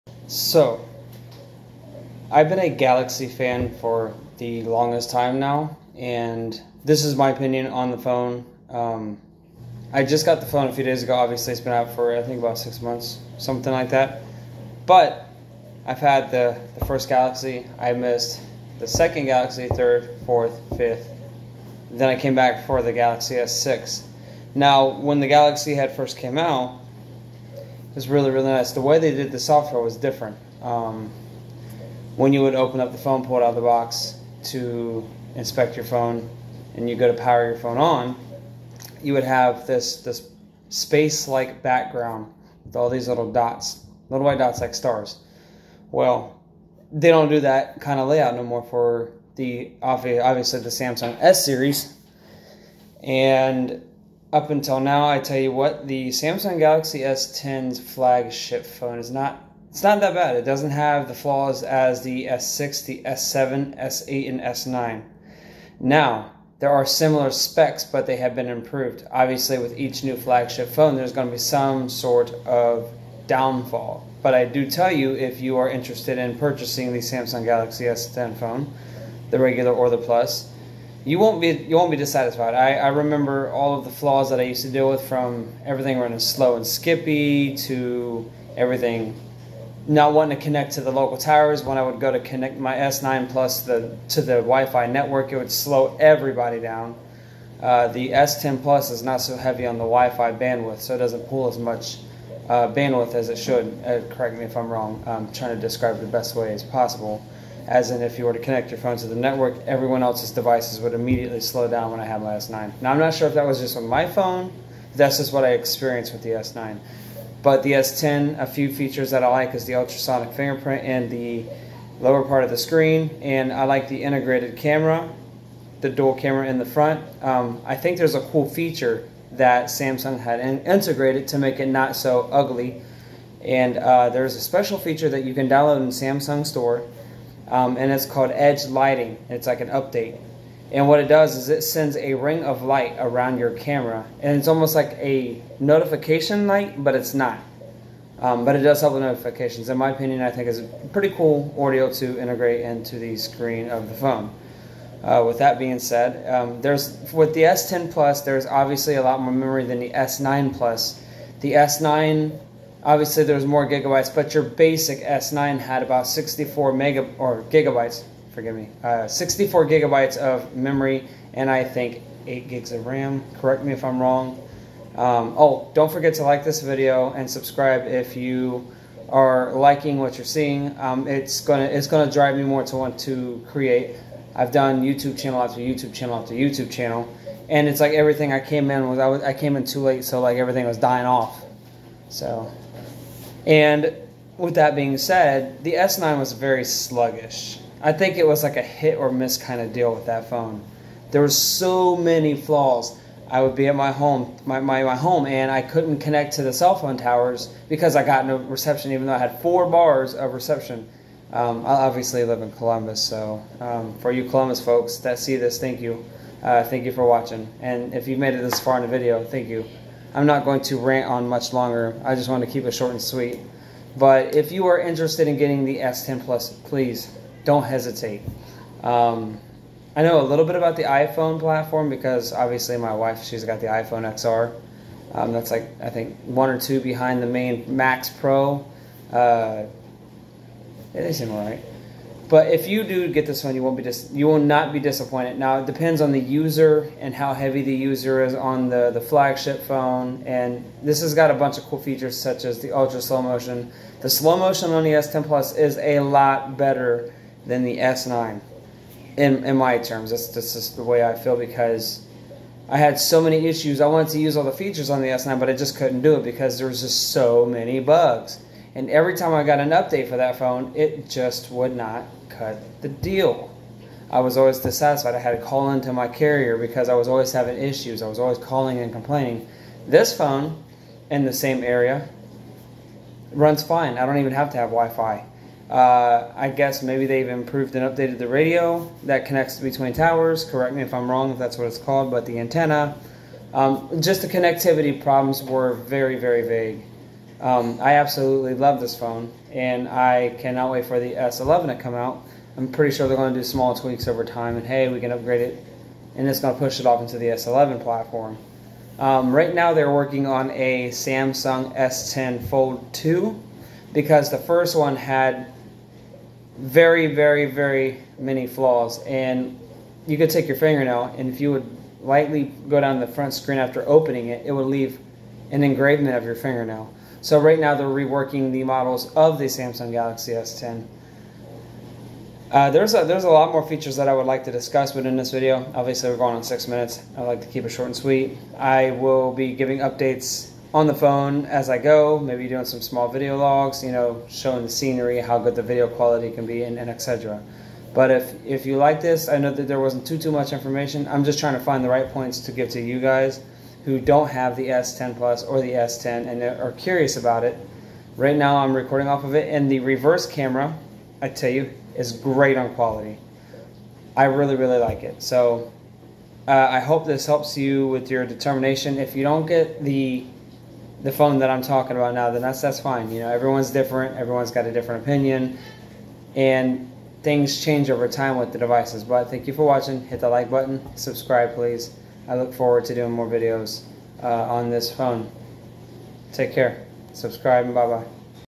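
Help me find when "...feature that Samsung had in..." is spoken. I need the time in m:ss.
2:08.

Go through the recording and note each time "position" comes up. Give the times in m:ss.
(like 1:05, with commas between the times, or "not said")
not said.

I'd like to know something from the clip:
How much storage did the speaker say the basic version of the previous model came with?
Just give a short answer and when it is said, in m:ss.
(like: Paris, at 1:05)
64 gigabytes, at 2:49.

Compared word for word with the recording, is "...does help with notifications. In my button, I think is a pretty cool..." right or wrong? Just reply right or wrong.
wrong.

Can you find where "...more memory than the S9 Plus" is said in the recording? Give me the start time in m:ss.
2:39.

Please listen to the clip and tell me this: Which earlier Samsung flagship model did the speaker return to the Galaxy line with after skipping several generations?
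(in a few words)
Galaxy S6.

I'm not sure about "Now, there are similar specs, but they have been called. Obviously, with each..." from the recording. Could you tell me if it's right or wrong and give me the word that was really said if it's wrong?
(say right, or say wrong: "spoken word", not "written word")
wrong: "improved", not "called".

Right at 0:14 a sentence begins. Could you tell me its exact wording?
But I've had the, the first Galaxy.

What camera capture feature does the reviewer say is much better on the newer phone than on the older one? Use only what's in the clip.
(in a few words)
ultra slow motion.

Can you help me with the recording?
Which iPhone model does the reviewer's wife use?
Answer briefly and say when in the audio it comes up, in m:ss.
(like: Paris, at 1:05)
iPhone XR, at 3:53.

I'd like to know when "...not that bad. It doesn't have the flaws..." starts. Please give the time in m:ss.
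0:59.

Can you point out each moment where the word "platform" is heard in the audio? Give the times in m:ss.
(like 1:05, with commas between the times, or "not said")
3:51, 5:07.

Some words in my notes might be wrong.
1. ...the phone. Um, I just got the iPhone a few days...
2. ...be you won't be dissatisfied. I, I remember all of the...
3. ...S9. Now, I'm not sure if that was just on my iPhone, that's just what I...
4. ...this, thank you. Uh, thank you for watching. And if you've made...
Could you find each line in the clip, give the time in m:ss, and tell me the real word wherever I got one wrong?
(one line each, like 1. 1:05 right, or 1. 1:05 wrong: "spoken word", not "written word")
1. 0:07 wrong: "phone", not "iPhone"
2. 1:21 right
3. 1:52 wrong: "phone", not "iPhone"
4. 3:35 right.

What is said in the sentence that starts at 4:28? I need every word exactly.
And every time I got an update for that phone, it just would not cut.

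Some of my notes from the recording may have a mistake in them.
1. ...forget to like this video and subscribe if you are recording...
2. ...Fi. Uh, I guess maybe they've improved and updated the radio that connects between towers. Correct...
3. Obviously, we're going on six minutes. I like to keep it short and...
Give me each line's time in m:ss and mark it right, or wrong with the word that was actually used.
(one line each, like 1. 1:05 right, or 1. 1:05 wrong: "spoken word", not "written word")
1. 2:55 wrong: "liking", not "recording"
2. 4:44 right
3. 5:35 right.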